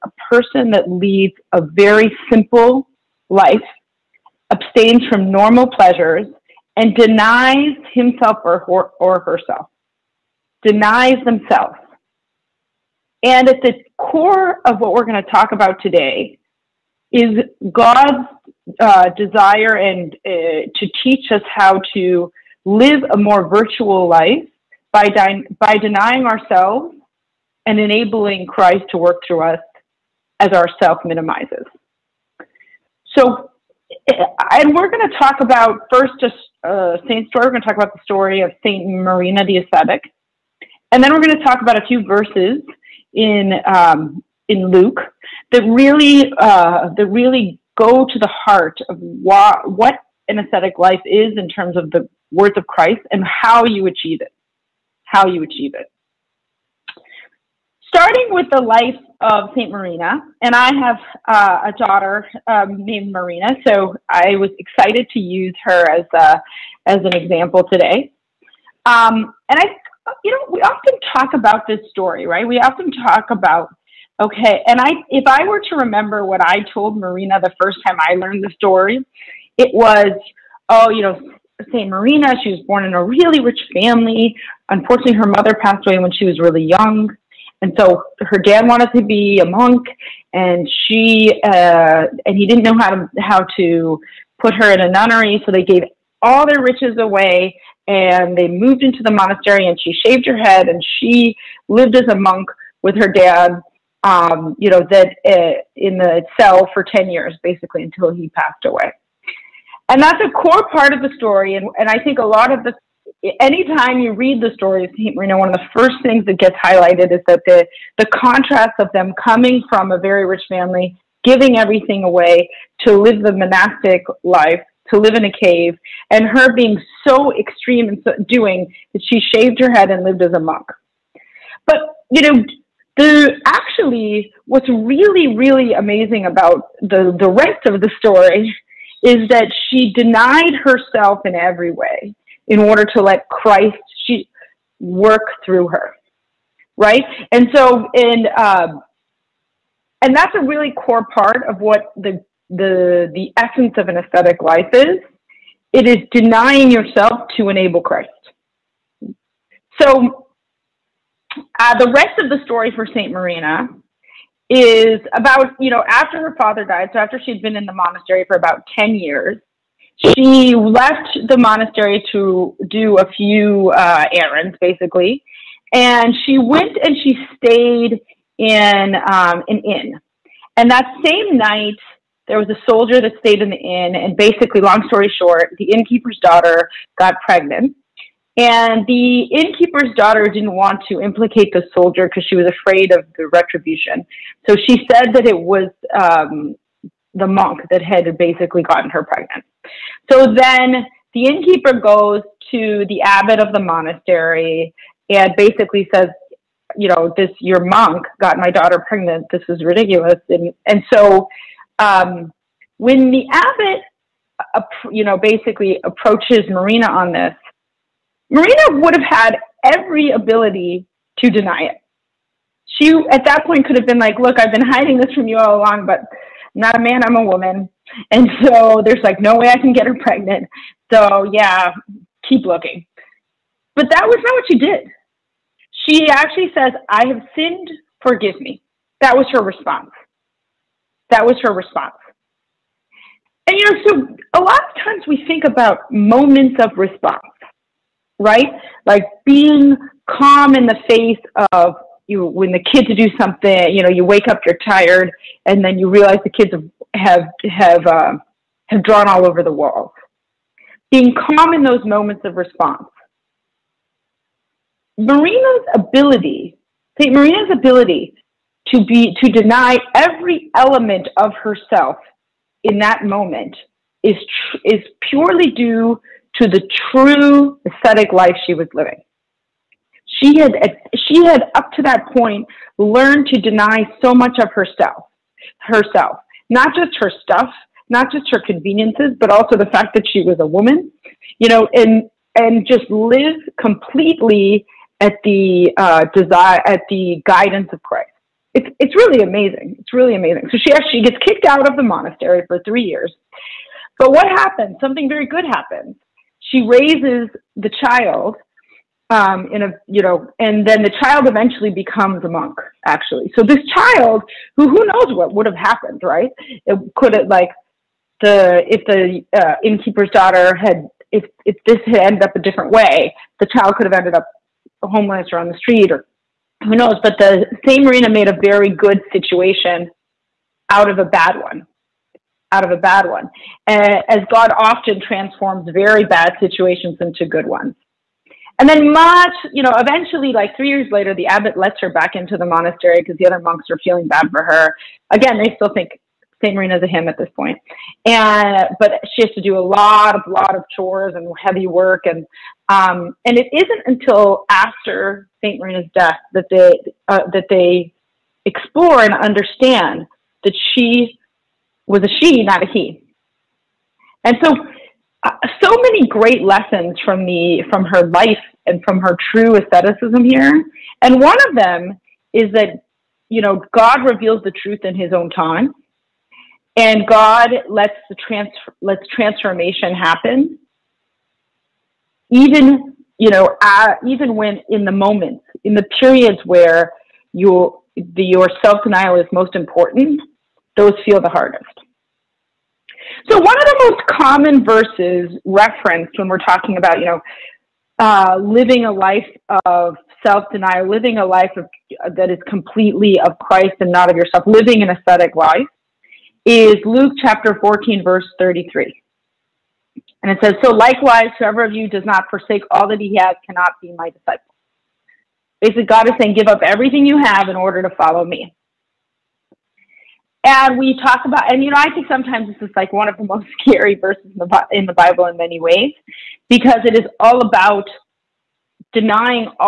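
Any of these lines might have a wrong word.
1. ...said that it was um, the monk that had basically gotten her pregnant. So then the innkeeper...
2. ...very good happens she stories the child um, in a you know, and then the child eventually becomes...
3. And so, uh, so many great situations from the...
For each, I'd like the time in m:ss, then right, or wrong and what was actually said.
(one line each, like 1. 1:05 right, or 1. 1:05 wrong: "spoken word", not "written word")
1. 3:14 right
2. 5:05 wrong: "raises", not "stories"
3. 6:04 wrong: "lessons", not "situations".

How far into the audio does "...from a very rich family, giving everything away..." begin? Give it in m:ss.
1:59.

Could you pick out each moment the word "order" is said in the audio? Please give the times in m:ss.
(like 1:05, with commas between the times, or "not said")
2:22, 6:57.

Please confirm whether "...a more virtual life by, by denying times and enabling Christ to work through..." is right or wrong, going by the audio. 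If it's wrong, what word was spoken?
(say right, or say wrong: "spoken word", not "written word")
wrong: "ourselves", not "times".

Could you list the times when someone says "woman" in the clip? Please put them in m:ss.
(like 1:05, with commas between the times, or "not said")
3:47, 4:50.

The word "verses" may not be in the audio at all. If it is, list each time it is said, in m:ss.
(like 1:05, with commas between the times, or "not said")
0:42, 6:34, 6:48, 7:03.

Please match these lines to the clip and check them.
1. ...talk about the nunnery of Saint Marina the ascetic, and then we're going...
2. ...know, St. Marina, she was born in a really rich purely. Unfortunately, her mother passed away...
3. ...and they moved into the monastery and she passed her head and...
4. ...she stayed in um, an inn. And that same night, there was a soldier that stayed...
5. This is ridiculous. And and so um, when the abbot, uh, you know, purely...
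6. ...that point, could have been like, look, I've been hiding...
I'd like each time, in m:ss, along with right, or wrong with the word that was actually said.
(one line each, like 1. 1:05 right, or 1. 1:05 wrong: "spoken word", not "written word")
1. 0:37 wrong: "story", not "nunnery"
2. 1:21 wrong: "family", not "purely"
3. 1:37 wrong: "shaved", not "passed"
4. 2:57 right
5. 3:29 wrong: "basically", not "purely"
6. 3:43 right.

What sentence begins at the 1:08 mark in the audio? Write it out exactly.
Um, and I, you know, we often talk about this story, right?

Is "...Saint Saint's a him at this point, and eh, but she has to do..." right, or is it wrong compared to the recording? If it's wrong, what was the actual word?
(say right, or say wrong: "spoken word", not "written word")
wrong: "Marina", not "Saint".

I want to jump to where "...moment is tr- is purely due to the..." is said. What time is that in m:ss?
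4:33.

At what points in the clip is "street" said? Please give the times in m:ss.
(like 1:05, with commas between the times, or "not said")
5:25.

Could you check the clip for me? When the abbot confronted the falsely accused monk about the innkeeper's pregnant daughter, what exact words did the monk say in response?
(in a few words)
I have sinned, forgive me.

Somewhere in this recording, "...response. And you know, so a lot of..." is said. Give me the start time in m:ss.
4:01.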